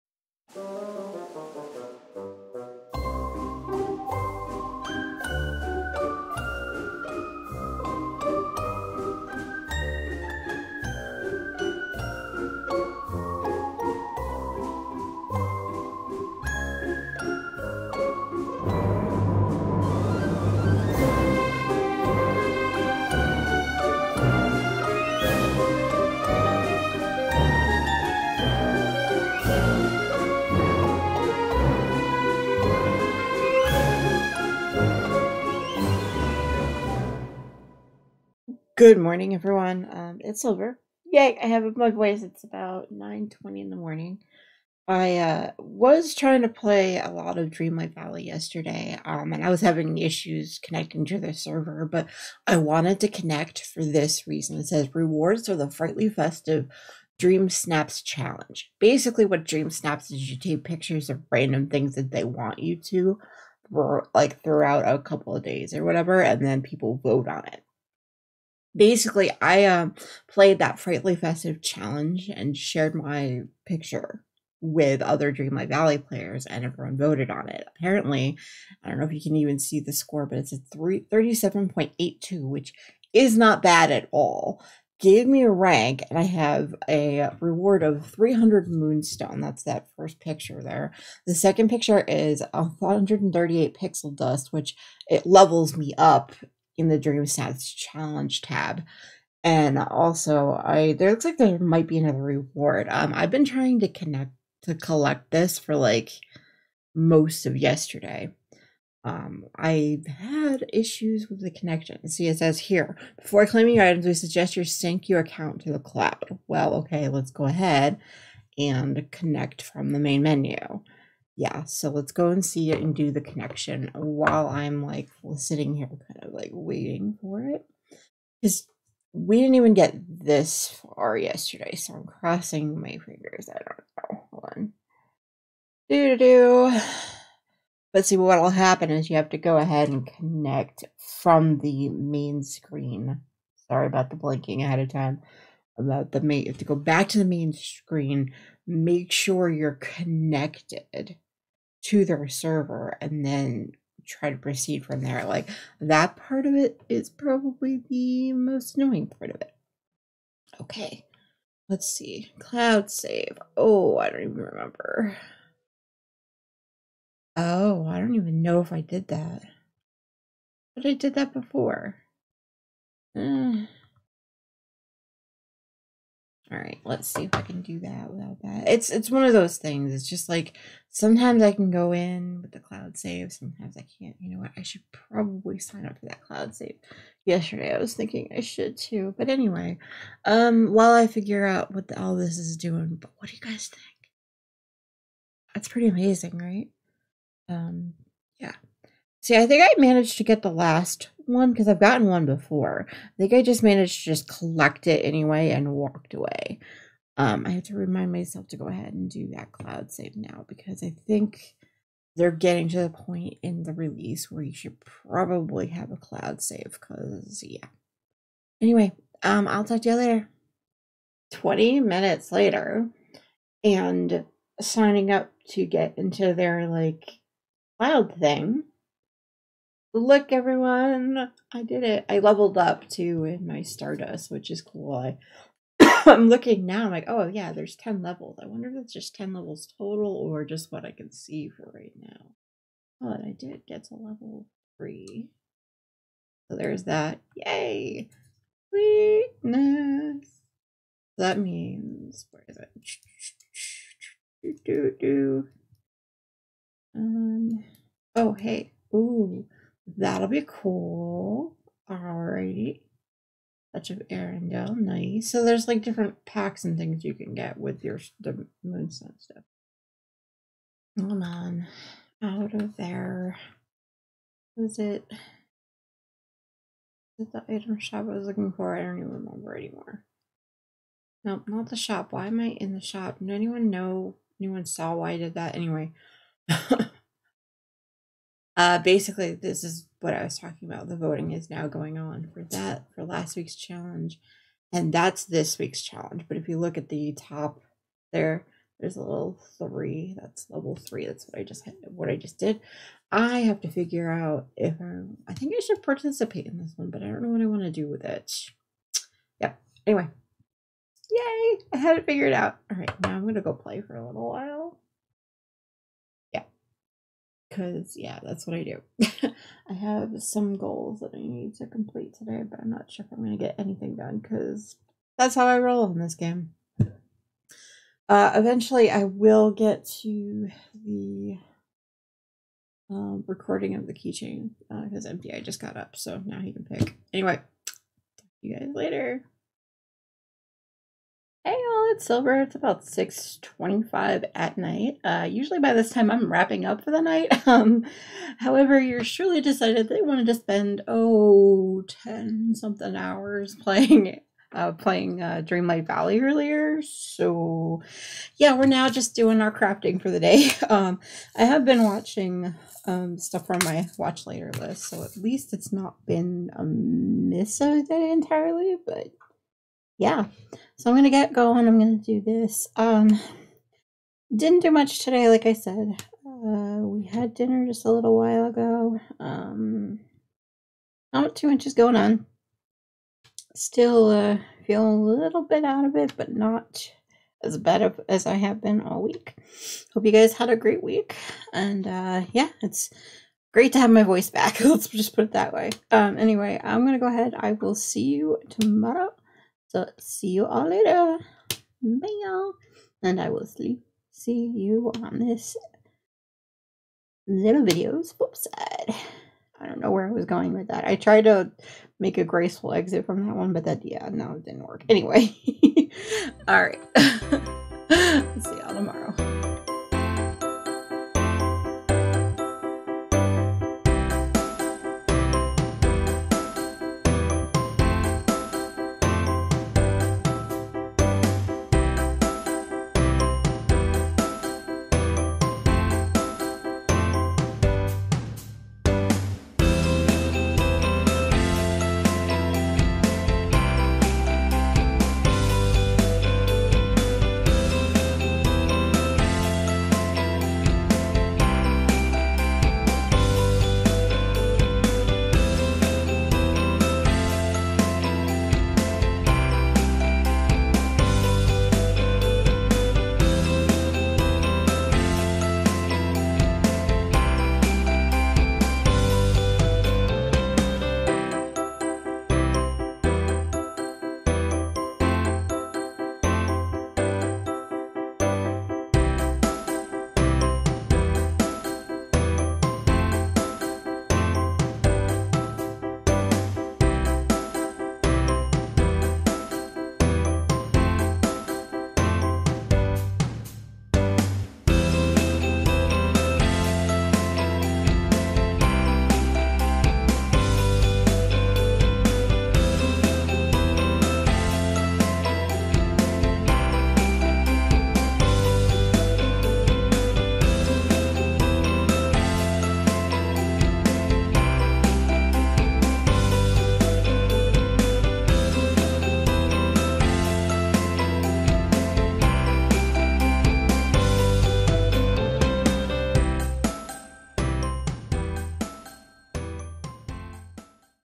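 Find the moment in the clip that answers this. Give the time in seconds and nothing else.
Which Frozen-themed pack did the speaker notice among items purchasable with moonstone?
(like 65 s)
263 s.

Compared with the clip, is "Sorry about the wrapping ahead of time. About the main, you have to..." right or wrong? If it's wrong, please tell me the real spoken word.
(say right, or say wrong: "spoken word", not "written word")
wrong: "blinking", not "wrapping".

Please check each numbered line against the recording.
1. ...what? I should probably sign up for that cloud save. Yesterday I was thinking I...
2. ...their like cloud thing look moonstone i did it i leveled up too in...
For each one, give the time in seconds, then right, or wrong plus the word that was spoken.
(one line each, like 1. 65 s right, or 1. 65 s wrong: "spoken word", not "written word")
1. 184 s right
2. 226 s wrong: "everyone", not "moonstone".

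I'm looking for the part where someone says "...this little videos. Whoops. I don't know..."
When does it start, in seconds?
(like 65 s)
405 s.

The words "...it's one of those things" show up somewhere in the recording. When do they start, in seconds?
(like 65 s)
178 s.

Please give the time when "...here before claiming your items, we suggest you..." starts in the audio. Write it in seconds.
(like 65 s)
112 s.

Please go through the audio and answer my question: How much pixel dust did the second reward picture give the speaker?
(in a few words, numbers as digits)
138.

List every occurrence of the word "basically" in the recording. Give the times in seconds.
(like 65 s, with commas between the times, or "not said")
58 s, 68 s, 288 s.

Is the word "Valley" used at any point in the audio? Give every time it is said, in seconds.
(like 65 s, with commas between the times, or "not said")
47 s, 75 s, 355 s.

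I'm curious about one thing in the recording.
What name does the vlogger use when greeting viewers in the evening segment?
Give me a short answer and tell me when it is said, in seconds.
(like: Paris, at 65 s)
Silver, at 342 s.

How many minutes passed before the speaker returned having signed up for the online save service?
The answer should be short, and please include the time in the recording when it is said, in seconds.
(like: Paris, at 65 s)
20, at 221 s.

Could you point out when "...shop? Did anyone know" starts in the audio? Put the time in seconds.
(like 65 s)
282 s.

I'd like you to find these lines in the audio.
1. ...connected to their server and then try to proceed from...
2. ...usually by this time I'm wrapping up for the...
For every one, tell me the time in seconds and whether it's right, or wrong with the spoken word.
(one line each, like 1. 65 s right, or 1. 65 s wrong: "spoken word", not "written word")
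1. 149 s right
2. 345 s right.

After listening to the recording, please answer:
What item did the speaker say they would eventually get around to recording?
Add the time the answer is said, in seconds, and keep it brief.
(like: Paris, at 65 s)
keychain, at 333 s.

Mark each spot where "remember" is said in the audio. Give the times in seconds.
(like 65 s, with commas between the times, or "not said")
164 s, 279 s.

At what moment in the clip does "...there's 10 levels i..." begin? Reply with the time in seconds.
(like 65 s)
237 s.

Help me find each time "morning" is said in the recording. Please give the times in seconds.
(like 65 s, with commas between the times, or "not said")
38 s, 43 s.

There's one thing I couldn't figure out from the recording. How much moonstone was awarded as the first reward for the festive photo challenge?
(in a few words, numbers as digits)
300.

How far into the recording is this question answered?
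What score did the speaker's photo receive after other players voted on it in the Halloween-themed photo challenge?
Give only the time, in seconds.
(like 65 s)
80 s.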